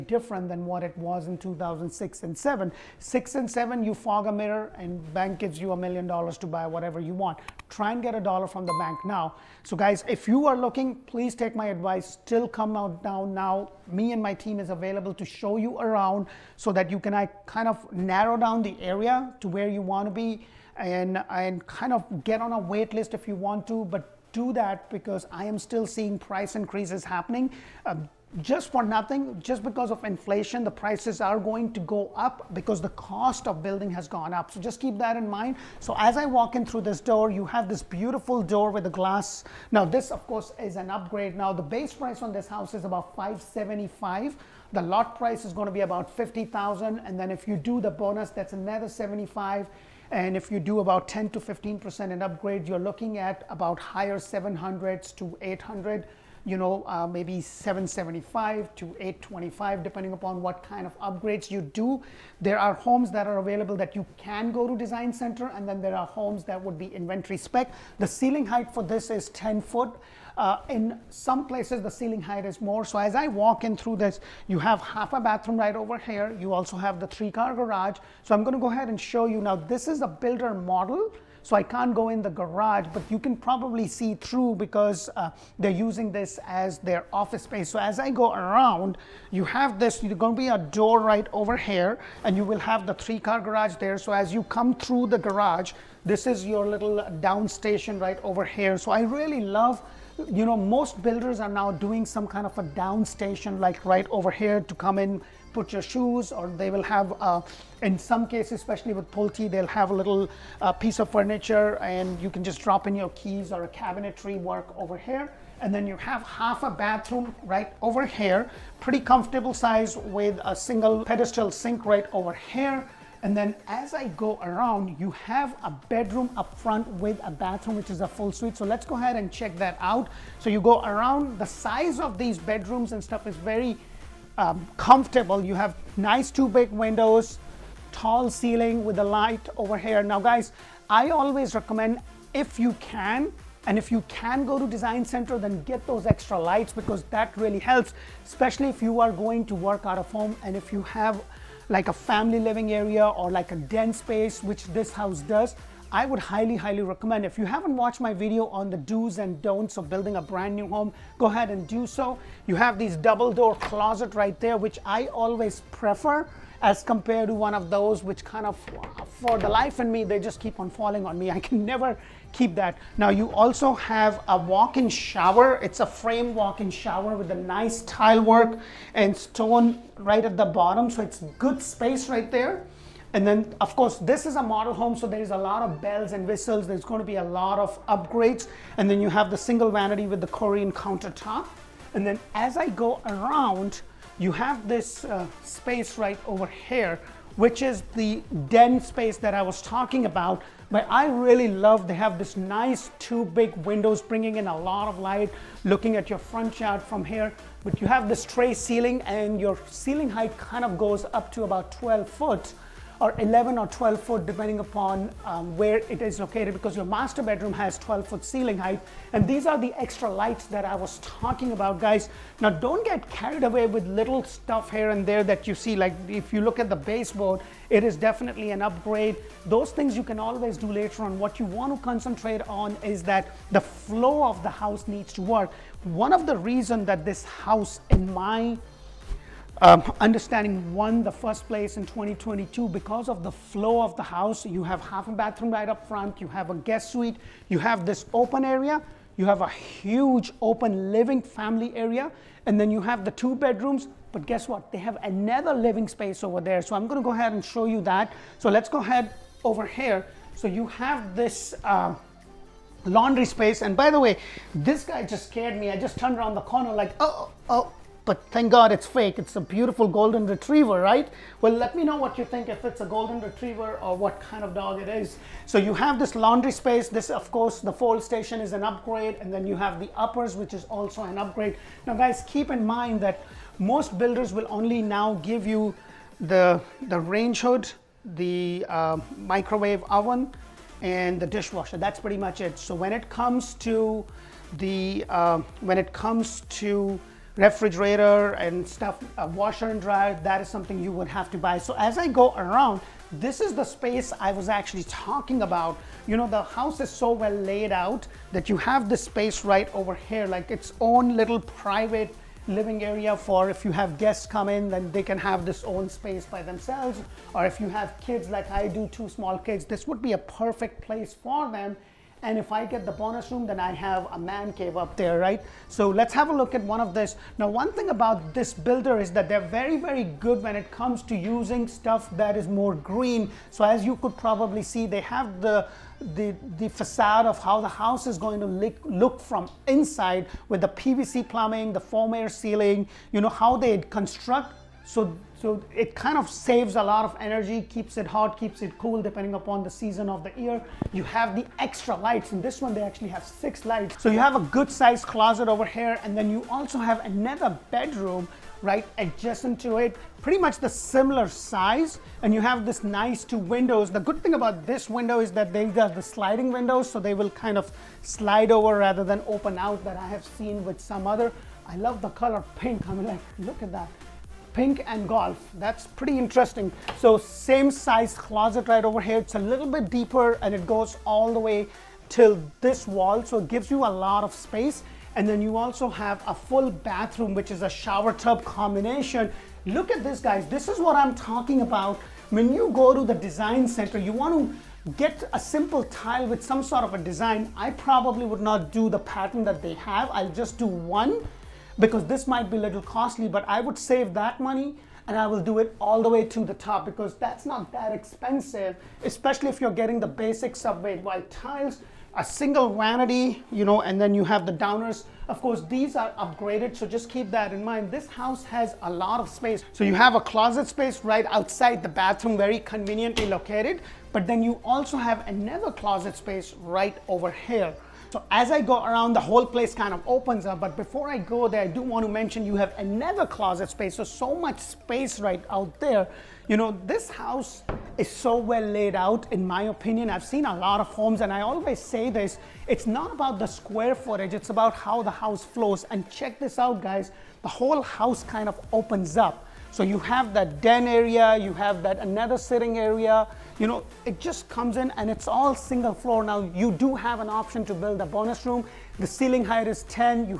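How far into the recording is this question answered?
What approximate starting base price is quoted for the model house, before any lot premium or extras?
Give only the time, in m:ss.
0:43.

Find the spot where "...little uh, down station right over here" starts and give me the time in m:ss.
1:36.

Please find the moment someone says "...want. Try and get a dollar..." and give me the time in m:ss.
0:07.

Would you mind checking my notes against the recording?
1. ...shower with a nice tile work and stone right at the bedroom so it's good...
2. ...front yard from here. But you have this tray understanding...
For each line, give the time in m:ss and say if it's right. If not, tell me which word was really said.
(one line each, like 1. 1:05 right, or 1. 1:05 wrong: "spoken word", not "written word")
1. 2:56 wrong: "bottom", not "bedroom"
2. 3:26 wrong: "ceiling", not "understanding".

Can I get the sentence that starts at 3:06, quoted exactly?
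There's going to be a lot of upgrades.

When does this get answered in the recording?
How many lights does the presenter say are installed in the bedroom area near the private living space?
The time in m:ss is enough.
5:53.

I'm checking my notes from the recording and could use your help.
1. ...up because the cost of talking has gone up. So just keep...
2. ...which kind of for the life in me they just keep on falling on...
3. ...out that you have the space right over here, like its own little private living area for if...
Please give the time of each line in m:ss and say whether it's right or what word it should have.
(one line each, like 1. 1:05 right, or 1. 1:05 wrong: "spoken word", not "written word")
1. 0:32 wrong: "building", not "talking"
2. 2:48 right
3. 5:07 right.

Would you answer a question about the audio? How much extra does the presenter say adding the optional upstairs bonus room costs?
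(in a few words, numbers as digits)
75.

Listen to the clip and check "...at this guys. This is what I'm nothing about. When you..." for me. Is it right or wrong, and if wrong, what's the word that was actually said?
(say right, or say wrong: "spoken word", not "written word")
wrong: "talking", not "nothing".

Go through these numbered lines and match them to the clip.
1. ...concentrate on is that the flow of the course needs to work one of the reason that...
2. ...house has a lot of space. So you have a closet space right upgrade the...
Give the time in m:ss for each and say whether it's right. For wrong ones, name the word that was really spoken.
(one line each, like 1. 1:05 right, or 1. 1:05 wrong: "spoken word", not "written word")
1. 3:51 wrong: "house", not "course"
2. 6:58 wrong: "outside", not "upgrade".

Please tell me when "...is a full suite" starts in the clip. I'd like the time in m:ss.
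2:07.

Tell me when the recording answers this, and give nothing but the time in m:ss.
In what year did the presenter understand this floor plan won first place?
4:01.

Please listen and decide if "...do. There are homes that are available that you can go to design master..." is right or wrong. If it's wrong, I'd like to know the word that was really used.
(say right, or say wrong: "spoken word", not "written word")
wrong: "center", not "master".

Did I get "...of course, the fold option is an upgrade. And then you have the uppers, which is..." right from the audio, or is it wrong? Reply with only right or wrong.
wrong.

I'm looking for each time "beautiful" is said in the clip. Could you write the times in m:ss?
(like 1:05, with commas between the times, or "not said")
0:37, 4:29.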